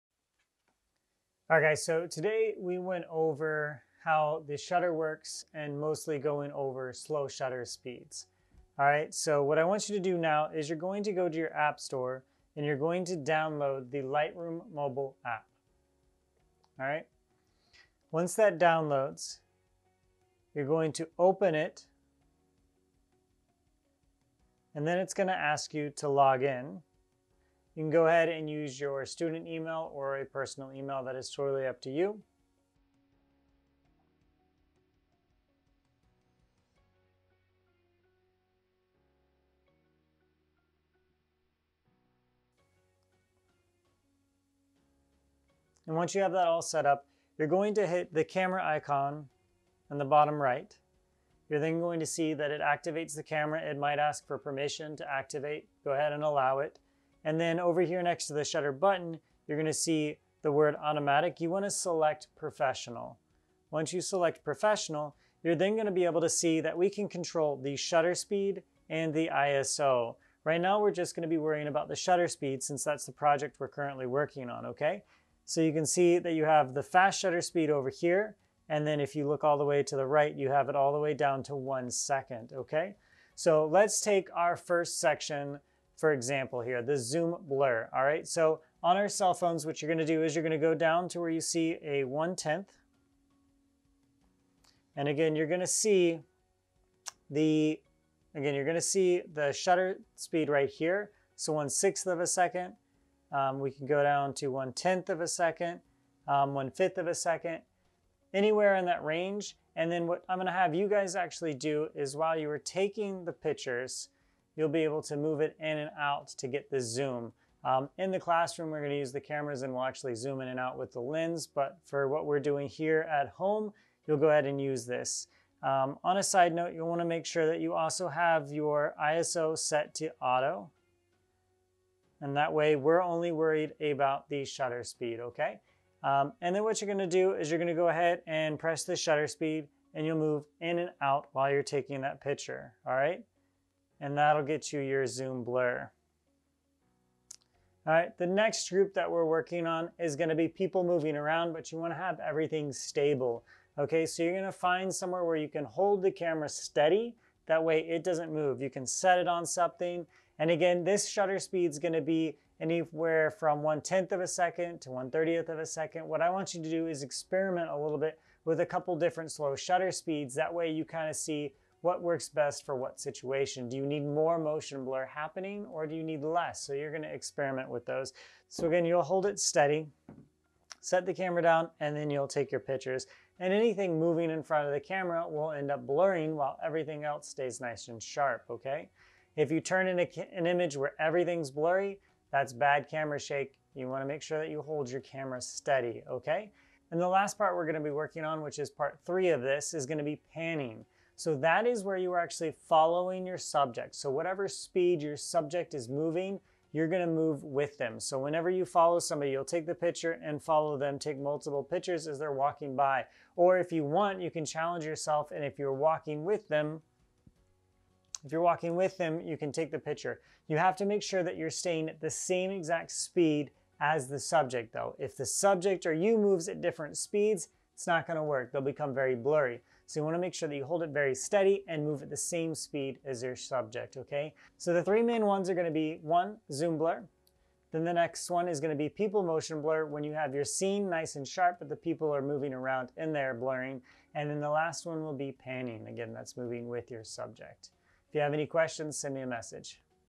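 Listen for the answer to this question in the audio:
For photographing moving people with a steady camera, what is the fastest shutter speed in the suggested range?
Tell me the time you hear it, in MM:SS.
02:44.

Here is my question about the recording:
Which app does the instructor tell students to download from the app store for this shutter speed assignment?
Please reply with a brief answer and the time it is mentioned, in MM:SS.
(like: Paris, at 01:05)
Lightroom mobile, at 00:13.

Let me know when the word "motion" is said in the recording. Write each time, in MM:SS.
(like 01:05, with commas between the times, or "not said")
02:54, 03:59.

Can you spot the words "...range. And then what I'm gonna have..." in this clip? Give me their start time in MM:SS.
01:49.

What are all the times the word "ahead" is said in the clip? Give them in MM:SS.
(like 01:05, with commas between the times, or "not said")
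00:28, 00:55, 02:04, 02:17.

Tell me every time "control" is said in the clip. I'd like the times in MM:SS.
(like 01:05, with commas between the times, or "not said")
01:07.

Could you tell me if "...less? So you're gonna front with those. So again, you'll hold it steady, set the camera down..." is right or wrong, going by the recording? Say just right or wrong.
wrong.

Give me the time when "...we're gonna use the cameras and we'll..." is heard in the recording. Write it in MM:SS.
01:58.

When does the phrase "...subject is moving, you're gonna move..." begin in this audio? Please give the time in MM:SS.
03:25.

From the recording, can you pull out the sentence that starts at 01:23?
So let's take our first section for example here, the zoom blur, all right?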